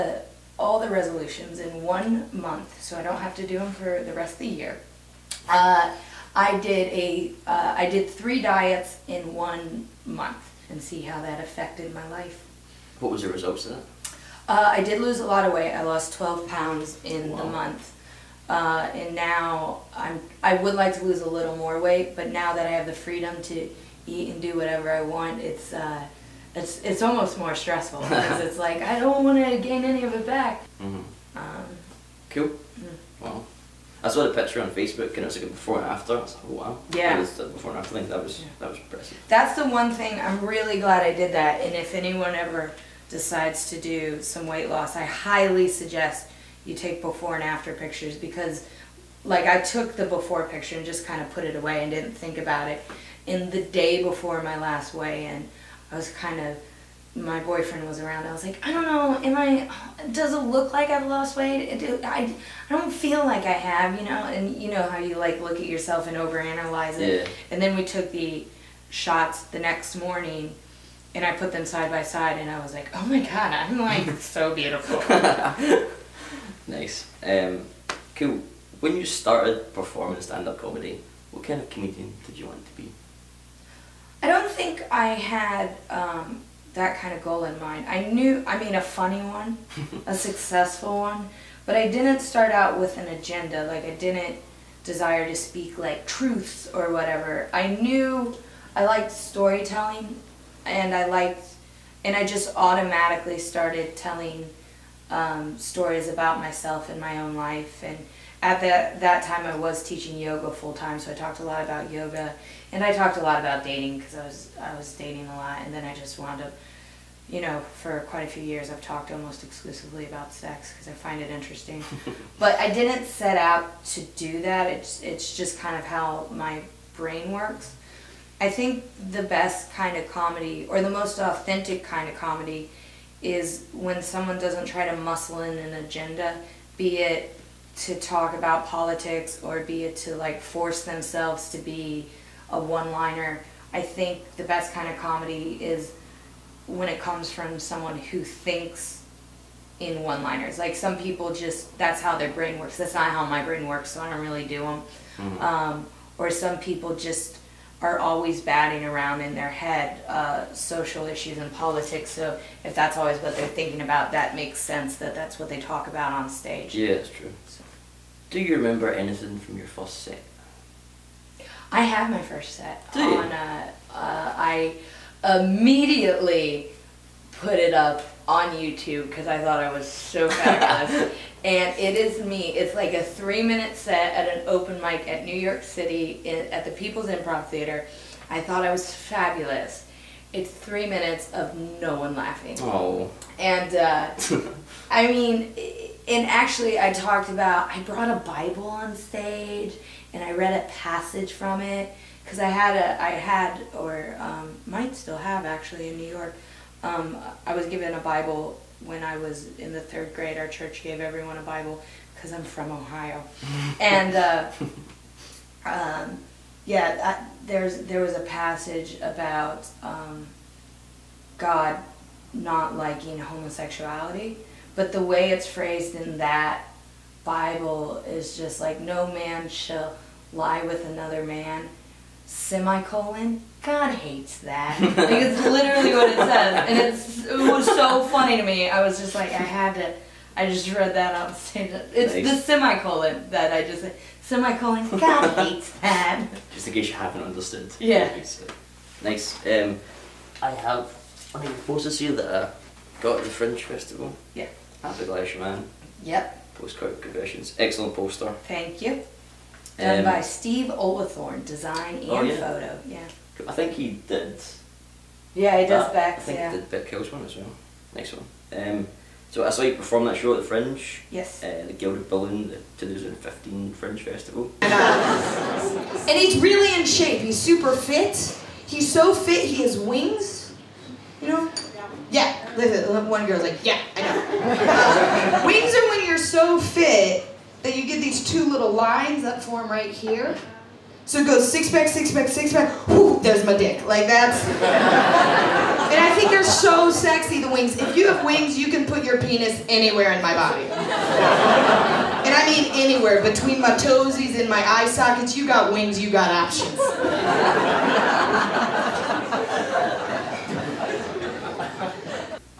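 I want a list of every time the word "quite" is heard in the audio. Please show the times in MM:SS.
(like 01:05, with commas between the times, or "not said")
01:58.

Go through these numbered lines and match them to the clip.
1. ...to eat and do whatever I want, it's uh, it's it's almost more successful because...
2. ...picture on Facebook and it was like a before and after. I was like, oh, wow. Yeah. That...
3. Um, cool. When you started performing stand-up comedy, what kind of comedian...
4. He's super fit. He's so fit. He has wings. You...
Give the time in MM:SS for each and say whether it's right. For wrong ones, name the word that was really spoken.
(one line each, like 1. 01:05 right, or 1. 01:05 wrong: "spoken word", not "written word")
1. 00:23 wrong: "stressful", not "successful"
2. 00:34 right
3. 01:17 right
4. 04:37 right.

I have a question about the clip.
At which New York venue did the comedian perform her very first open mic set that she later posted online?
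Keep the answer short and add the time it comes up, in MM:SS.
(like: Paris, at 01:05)
People's Improv Theater, at 03:06.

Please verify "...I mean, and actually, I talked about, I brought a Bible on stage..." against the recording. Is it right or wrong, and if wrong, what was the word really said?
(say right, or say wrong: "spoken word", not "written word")
right.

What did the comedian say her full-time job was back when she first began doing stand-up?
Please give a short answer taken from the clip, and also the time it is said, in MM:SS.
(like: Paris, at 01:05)
teaching yoga, at 01:49.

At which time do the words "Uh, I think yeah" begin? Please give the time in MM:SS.
04:26.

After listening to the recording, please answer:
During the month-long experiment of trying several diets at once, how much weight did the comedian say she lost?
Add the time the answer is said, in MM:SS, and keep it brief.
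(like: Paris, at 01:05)
12 pounds, at 00:16.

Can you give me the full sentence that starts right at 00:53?
In the day before my last weigh-in, I was kind of my boyfriend was around.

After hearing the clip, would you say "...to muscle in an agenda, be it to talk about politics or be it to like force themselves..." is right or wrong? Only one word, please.
right.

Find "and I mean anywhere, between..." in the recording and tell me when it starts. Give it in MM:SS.
05:00.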